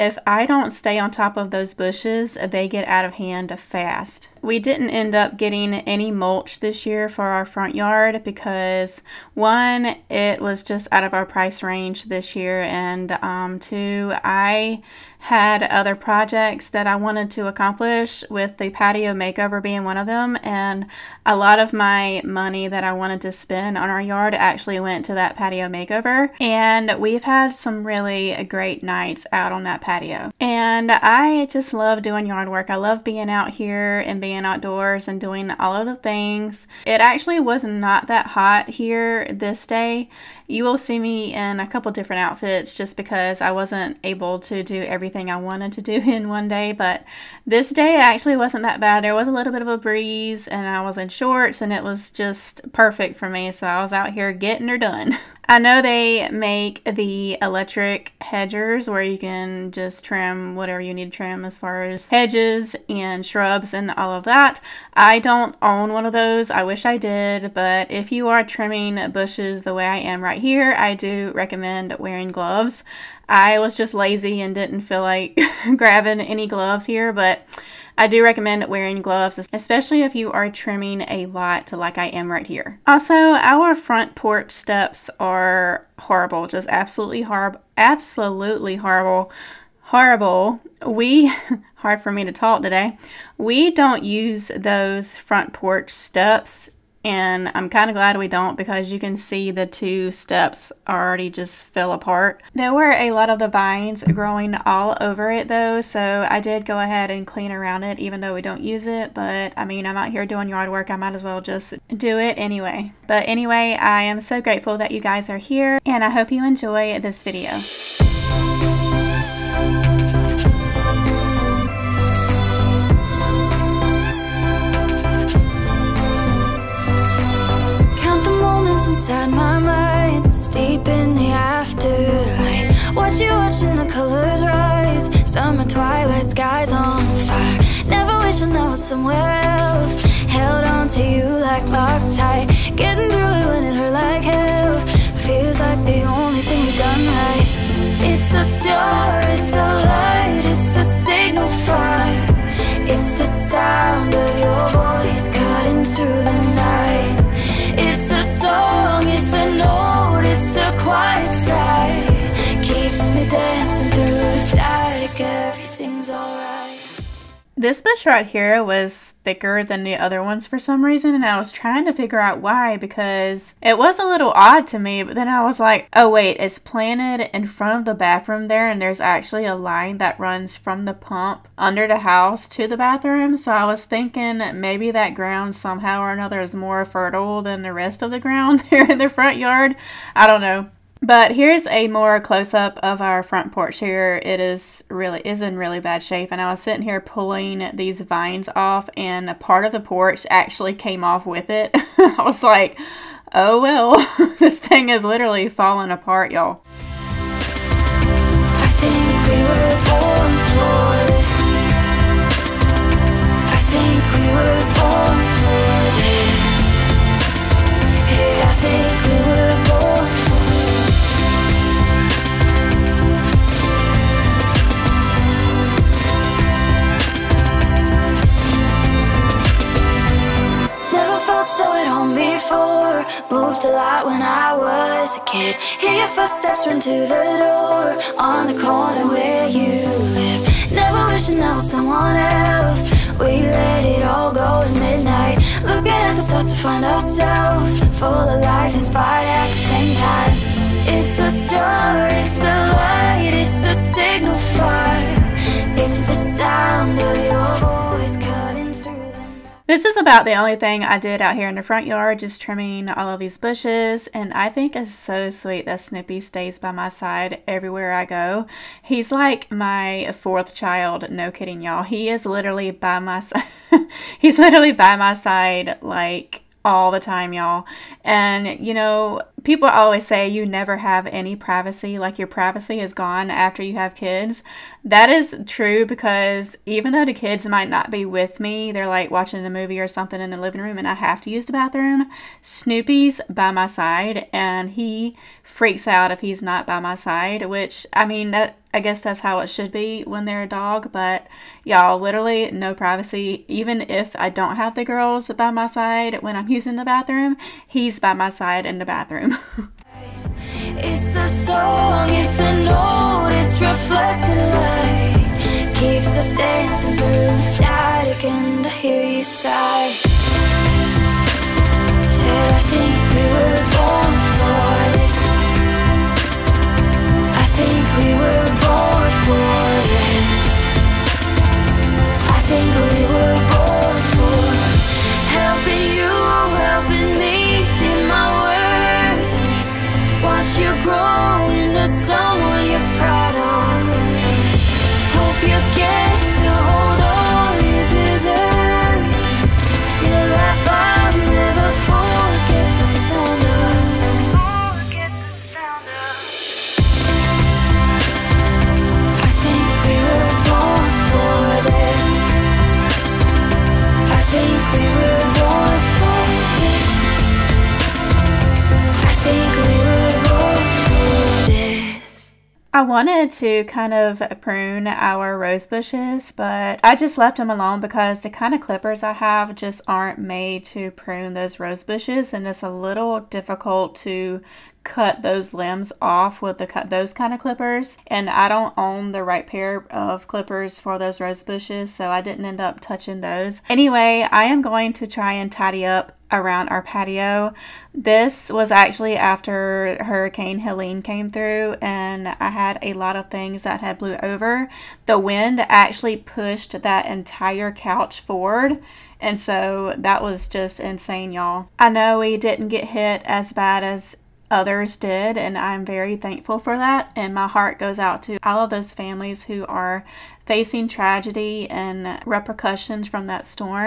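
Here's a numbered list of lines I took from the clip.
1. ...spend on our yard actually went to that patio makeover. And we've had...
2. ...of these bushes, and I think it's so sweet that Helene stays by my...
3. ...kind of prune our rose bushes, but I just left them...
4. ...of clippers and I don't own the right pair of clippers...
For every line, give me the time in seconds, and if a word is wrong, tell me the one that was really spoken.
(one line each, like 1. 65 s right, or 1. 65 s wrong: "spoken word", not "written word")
1. 23 s right
2. 263 s wrong: "Snoopy", not "Helene"
3. 373 s right
4. 387 s right.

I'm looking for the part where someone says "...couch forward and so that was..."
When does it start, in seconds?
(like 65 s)
407 s.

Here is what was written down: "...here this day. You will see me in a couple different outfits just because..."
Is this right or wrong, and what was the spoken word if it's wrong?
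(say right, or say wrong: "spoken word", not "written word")
right.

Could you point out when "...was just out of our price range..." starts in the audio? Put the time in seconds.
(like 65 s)
10 s.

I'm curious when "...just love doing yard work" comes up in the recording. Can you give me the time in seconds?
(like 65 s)
31 s.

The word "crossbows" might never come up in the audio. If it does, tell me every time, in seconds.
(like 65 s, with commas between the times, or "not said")
not said.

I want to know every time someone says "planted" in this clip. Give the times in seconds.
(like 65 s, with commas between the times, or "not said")
176 s.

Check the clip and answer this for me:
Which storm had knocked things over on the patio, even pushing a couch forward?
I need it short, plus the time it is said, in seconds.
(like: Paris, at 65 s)
Hurricane Helene, at 400 s.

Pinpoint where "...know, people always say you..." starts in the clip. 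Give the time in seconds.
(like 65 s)
278 s.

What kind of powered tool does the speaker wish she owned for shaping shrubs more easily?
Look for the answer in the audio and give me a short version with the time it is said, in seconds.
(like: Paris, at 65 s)
Electric hedgers, at 57 s.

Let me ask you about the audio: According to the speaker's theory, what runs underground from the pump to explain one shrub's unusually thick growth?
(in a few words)
A line.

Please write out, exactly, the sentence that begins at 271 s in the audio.
He is literally by my side.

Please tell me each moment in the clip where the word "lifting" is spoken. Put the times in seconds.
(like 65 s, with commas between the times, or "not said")
not said.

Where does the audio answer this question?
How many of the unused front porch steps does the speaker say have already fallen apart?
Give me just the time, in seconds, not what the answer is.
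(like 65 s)
99 s.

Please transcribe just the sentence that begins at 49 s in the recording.
There was a little bit of a breeze, and I was in shorts, and it was just perfect for me.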